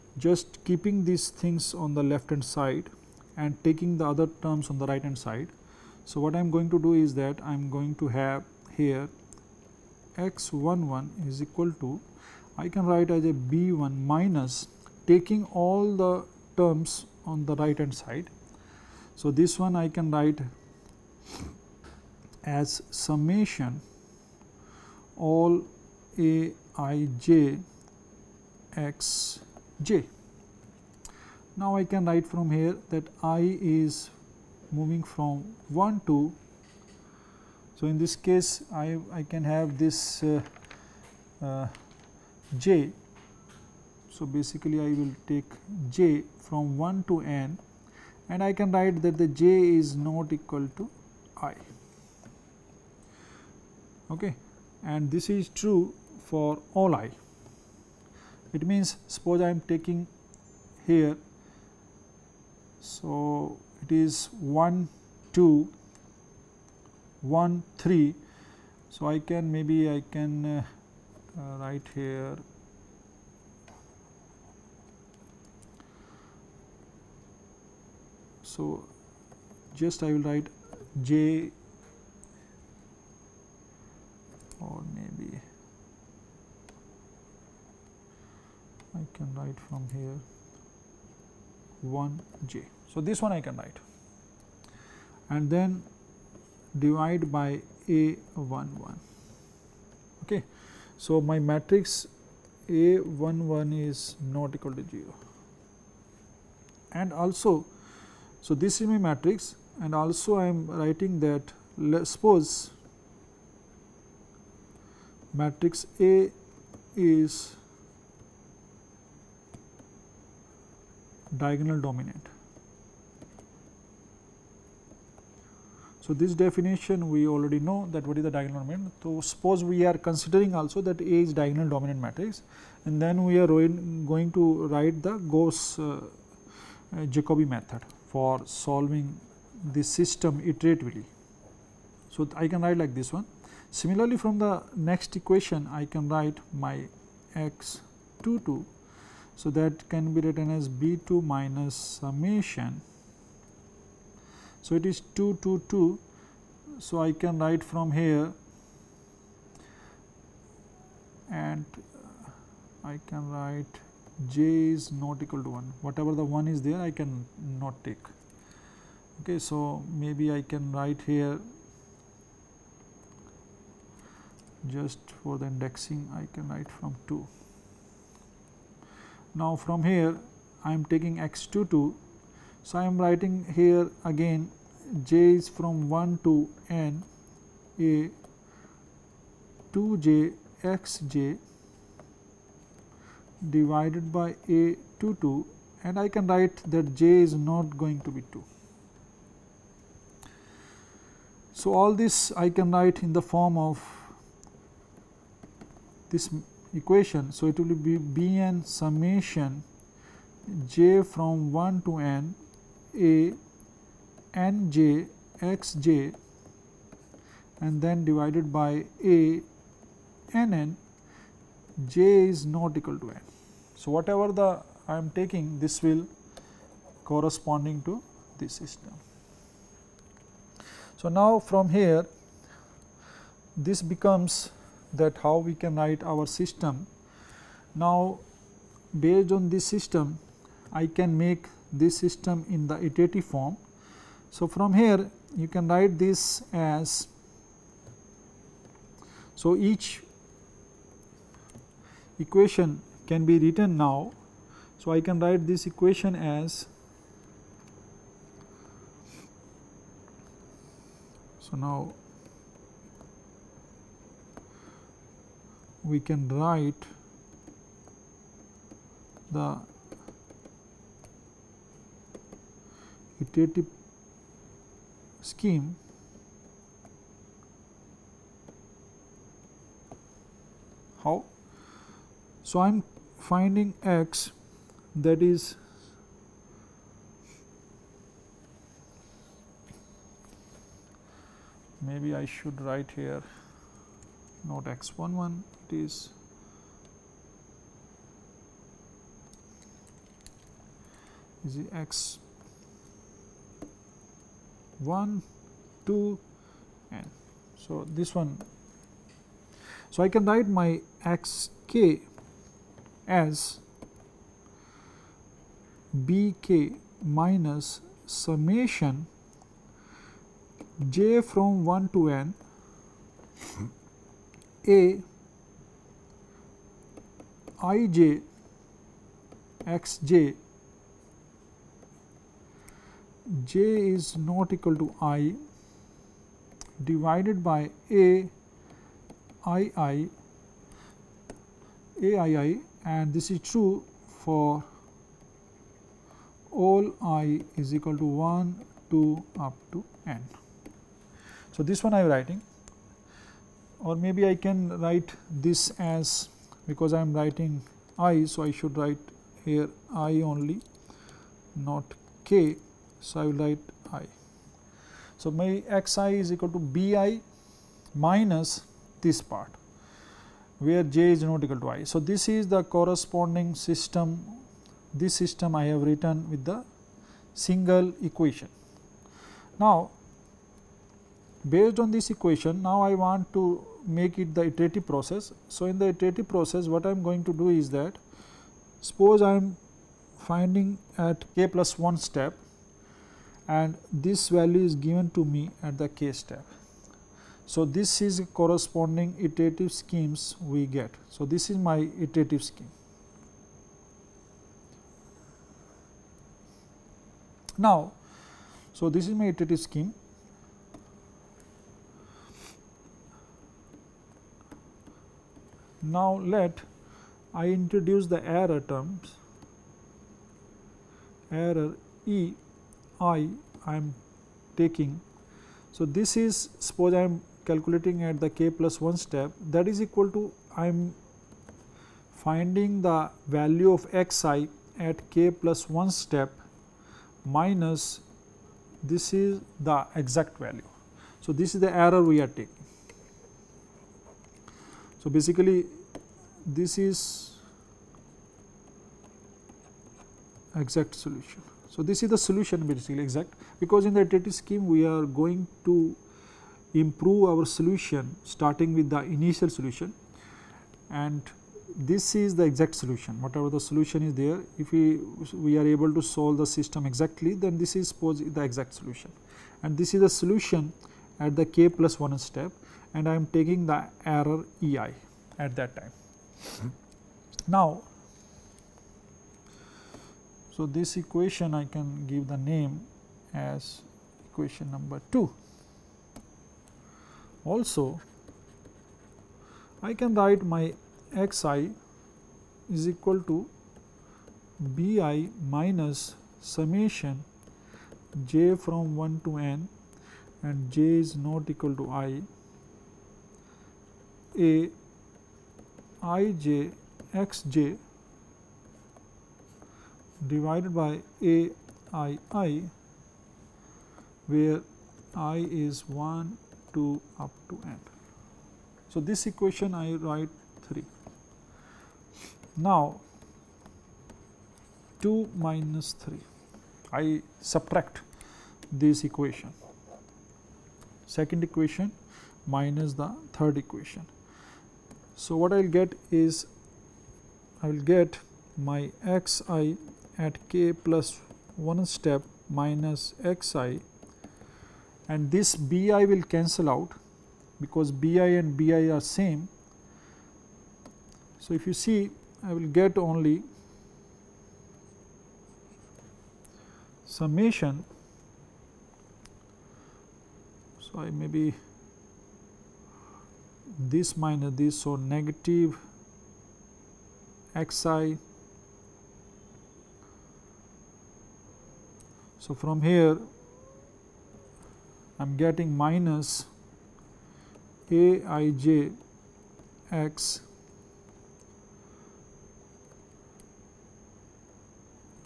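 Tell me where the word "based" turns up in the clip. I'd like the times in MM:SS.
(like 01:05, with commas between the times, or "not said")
03:58, 06:21.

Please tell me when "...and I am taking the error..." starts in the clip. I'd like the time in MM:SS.
07:52.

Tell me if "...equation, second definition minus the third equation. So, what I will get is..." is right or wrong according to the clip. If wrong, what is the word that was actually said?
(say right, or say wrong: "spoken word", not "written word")
wrong: "equation", not "definition".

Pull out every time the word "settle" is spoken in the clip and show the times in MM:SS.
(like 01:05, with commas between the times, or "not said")
not said.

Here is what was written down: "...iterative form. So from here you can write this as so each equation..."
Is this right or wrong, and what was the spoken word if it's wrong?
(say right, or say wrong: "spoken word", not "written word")
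right.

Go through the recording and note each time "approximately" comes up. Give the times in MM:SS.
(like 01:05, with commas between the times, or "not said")
not said.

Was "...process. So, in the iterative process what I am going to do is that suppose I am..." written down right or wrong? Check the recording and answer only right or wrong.
right.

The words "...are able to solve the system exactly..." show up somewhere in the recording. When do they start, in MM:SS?
07:45.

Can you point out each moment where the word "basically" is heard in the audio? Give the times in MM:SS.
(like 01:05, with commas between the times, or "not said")
00:44, 07:25, 07:32.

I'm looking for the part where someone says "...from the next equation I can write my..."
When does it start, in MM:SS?
02:24.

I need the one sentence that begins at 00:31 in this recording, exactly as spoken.
Now, I can write from here that i is moving from 1 to.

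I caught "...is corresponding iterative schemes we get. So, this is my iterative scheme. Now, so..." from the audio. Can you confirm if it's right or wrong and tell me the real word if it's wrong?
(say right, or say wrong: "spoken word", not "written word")
right.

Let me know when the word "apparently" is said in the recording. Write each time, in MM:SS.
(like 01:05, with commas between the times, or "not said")
not said.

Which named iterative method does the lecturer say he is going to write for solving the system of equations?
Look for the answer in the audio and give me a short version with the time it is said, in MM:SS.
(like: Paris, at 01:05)
Jacobi method, at 02:17.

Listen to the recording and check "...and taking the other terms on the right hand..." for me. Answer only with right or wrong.
right.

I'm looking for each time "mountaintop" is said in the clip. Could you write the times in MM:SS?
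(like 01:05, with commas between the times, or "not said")
not said.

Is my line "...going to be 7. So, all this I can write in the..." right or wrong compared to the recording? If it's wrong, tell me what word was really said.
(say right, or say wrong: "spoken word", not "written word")
wrong: "2", not "7".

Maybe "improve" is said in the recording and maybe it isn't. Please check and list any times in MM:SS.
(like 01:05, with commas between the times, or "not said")
07:36.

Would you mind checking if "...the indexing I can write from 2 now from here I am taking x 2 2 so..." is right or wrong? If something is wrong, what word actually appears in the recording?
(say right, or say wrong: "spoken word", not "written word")
right.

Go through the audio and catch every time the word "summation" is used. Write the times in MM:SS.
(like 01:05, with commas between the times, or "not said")
00:22, 02:31, 03:28, 05:18, 08:16, 09:17.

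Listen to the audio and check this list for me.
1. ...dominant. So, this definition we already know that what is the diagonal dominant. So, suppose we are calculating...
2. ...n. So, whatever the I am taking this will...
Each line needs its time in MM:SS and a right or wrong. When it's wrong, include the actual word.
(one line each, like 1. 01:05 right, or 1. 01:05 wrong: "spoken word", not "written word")
1. 02:01 wrong: "considering", not "calculating"
2. 03:43 right.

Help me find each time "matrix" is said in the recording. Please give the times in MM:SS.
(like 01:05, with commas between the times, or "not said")
01:41, 01:48, 01:55, 02:12.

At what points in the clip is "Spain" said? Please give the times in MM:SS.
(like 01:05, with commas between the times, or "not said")
not said.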